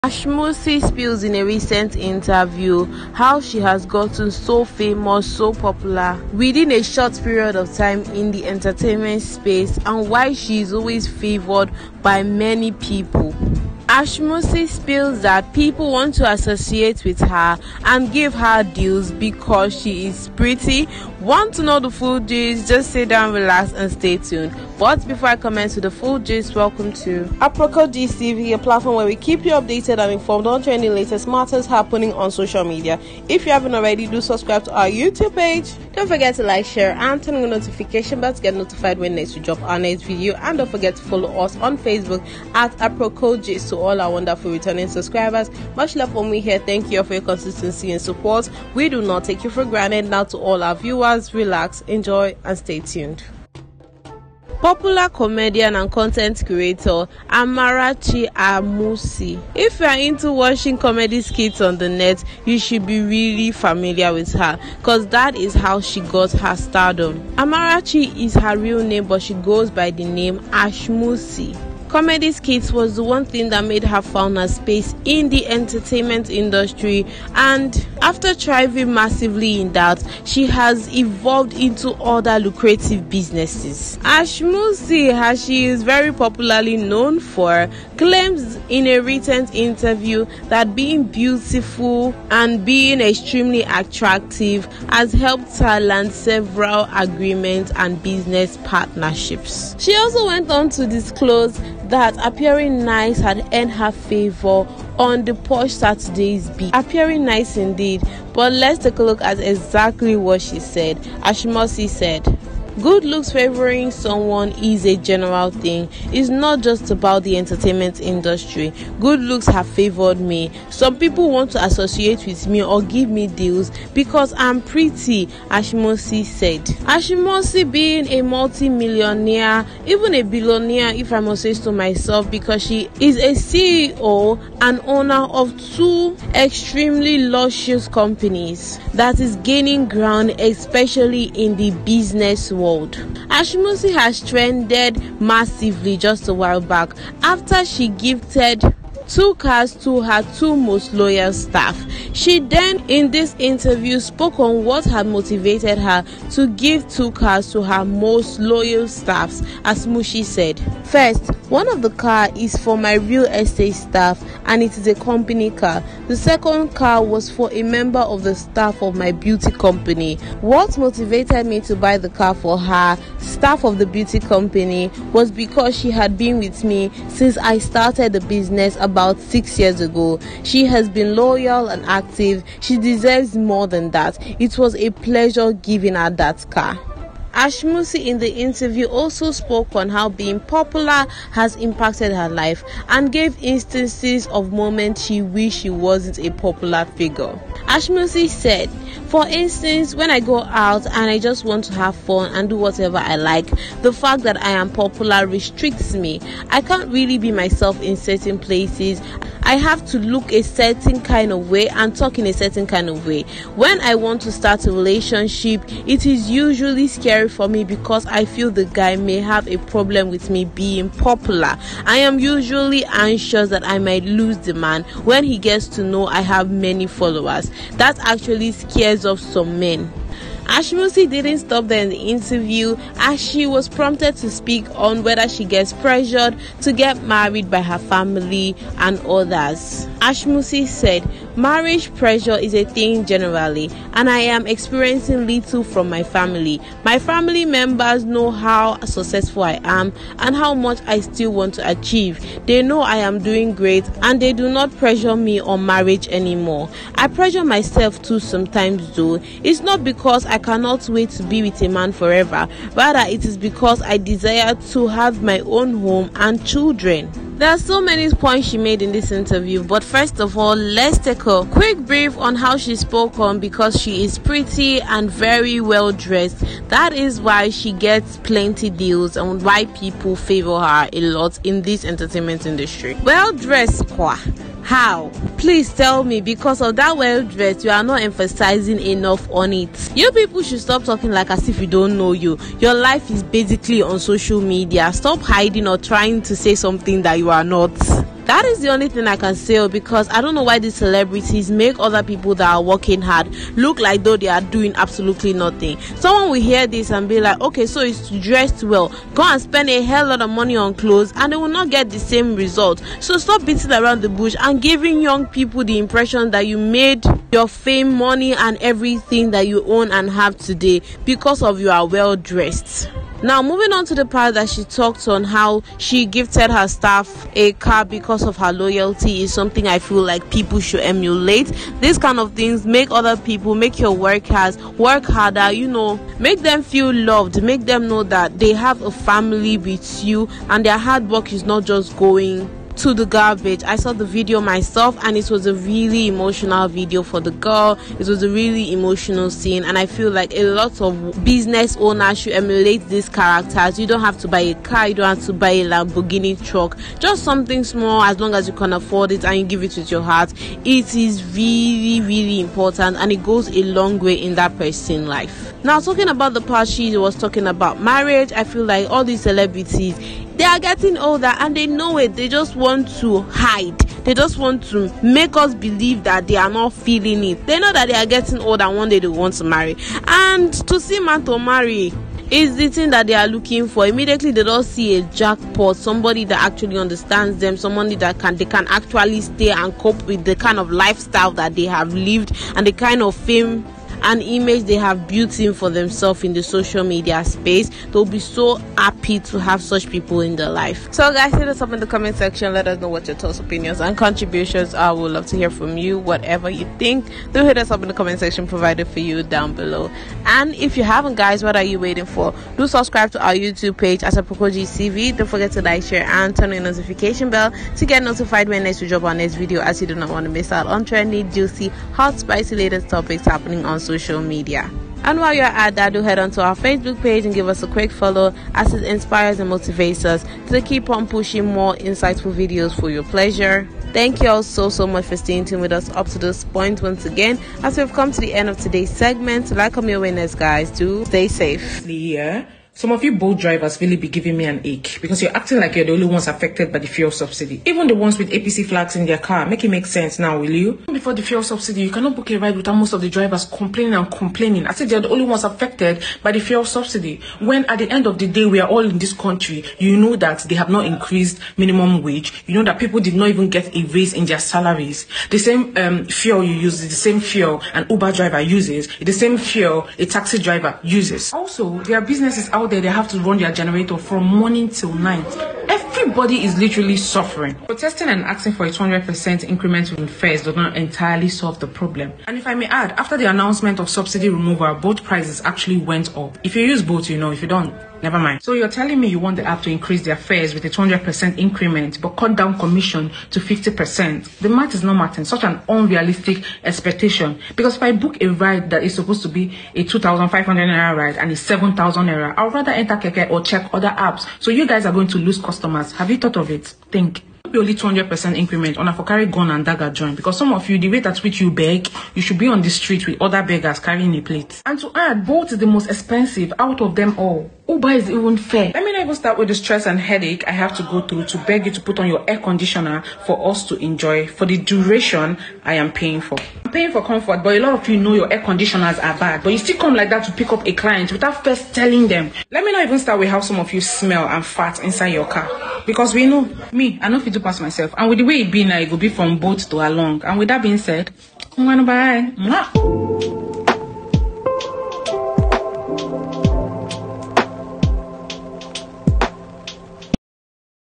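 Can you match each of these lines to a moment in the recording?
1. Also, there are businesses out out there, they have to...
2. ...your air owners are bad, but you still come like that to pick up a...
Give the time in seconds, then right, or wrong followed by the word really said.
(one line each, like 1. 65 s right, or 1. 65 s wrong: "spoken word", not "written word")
1. 471 s right
2. 528 s wrong: "conditioners", not "owners".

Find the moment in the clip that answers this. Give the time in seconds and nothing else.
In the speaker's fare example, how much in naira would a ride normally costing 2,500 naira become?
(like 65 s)
501 s.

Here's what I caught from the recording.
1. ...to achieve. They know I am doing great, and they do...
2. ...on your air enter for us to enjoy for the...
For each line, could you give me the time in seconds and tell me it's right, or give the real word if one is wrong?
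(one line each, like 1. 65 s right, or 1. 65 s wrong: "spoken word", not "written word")
1. 251 s right
2. 521 s wrong: "conditioner", not "enter".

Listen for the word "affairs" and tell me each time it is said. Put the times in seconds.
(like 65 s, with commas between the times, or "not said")
not said.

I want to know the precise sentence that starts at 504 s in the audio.
So you guys are going to lose customers.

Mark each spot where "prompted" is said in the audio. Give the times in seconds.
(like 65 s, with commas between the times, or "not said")
233 s.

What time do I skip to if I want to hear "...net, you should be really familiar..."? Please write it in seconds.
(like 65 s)
61 s.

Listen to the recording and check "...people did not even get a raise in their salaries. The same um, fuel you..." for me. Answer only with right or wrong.
right.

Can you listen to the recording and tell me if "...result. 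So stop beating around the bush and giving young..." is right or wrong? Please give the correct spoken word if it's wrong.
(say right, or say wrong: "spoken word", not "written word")
right.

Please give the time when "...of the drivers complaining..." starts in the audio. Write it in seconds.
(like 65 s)
452 s.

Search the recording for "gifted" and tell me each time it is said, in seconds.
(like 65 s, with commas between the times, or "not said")
147 s, 326 s.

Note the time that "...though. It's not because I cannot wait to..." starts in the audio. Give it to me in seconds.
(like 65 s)
258 s.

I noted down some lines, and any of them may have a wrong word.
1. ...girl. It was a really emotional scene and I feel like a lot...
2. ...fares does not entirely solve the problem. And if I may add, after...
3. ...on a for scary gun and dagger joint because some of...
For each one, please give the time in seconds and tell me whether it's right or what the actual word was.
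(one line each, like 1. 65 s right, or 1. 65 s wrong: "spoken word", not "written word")
1. 347 s right
2. 480 s right
3. 508 s wrong: "carry", not "scary".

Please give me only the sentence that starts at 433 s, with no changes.
Thank you all so, so much for staying tuned with us up to this point once again.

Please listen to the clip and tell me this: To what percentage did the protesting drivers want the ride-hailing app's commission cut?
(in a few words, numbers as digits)
50%.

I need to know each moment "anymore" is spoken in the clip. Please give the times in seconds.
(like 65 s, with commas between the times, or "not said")
256 s.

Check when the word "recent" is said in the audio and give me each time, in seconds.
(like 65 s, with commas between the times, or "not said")
1 s, 89 s.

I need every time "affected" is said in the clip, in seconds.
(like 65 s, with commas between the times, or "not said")
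446 s, 455 s.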